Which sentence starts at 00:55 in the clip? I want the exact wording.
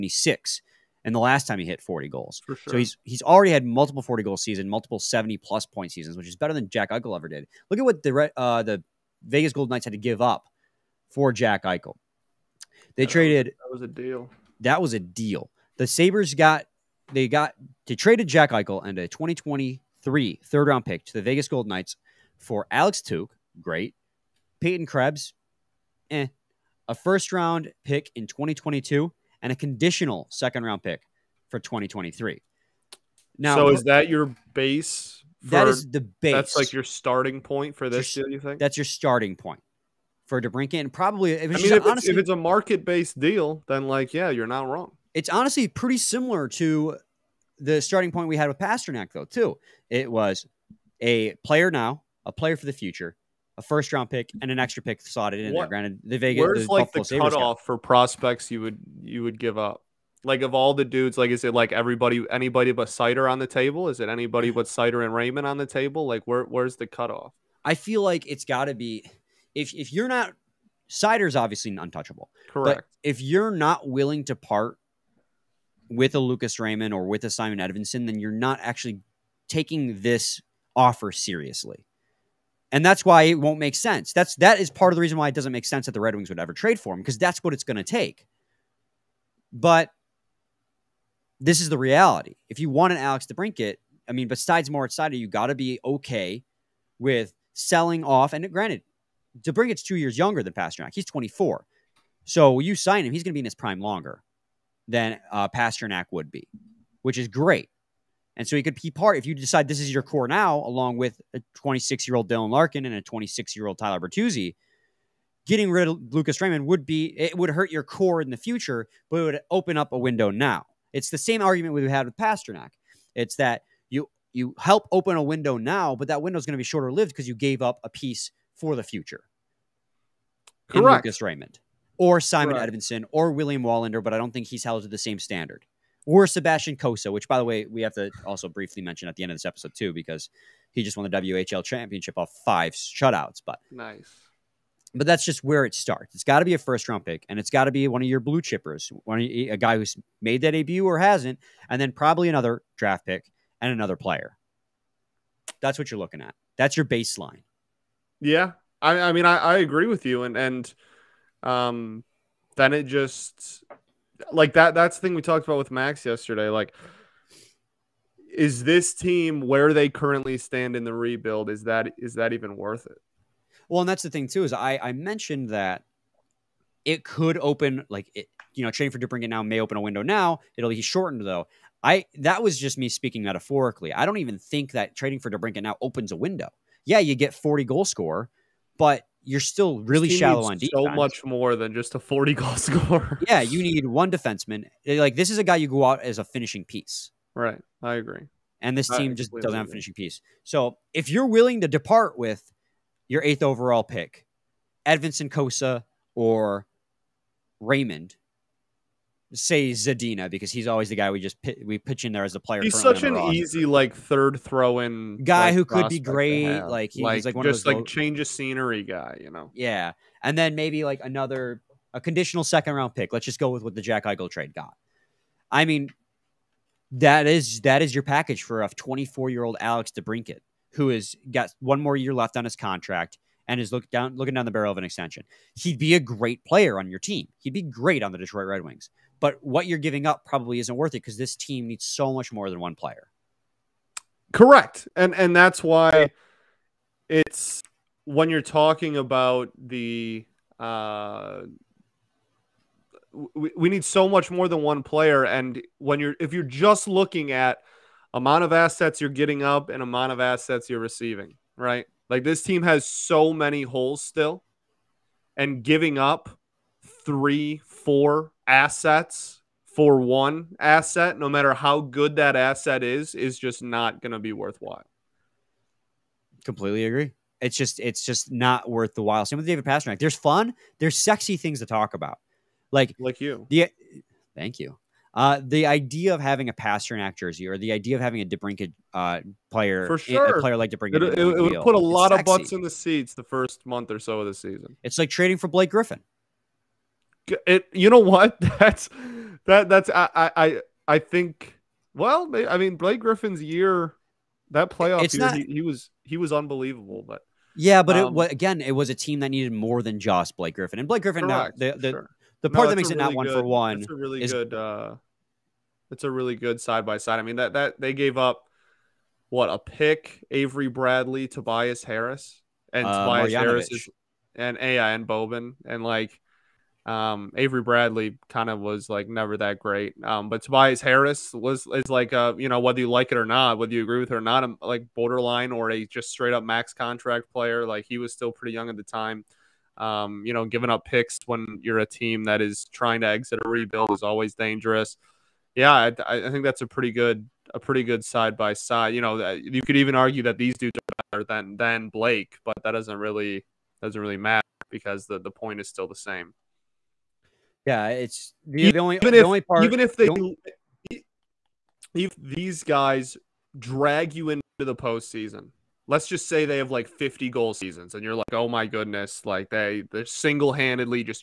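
Granted, the Vegas where's the like Buffalo the cutoff for prospects you would you would give up?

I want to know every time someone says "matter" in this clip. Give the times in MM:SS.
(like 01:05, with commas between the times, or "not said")
04:31, 05:54.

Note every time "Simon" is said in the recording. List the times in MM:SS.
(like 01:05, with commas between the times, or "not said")
01:17, 02:12.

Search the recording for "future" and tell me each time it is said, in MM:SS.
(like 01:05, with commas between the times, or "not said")
00:52, 01:58, 02:08.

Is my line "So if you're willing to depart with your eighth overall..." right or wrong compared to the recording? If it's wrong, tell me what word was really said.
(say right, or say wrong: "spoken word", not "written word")
right.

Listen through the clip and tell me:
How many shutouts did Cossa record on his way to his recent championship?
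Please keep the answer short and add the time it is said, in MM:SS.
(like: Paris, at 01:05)
5, at 02:22.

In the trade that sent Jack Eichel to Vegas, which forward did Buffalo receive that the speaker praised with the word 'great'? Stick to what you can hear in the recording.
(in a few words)
Alex Tuch.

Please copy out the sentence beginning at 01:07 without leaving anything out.
I feel like it's got to be if if you're not Seider's obviously untouchable.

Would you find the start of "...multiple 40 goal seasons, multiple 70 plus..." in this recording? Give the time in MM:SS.
00:03.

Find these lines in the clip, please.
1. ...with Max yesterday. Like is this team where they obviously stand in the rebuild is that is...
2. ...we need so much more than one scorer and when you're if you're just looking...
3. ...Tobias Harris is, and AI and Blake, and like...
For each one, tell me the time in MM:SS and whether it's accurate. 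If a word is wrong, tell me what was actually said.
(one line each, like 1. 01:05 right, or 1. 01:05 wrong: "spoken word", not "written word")
1. 02:45 wrong: "currently", not "obviously"
2. 04:13 wrong: "player", not "scorer"
3. 05:23 wrong: "Boban", not "Blake".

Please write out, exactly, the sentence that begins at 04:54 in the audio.
It's like trading for Blake Griffin.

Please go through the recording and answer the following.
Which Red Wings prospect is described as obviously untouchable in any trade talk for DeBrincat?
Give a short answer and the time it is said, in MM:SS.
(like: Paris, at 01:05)
Moritz Seider, at 01:34.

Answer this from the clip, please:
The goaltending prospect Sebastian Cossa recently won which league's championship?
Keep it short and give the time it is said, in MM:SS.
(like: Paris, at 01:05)
WHL, at 02:21.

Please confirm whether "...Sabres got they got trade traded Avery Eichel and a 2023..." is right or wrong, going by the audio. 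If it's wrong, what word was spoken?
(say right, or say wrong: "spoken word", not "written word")
wrong: "Jack", not "Avery".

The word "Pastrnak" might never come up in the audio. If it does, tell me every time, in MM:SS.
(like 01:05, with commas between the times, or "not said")
00:48, 01:40, 01:45, 02:02, 04:39, 04:46.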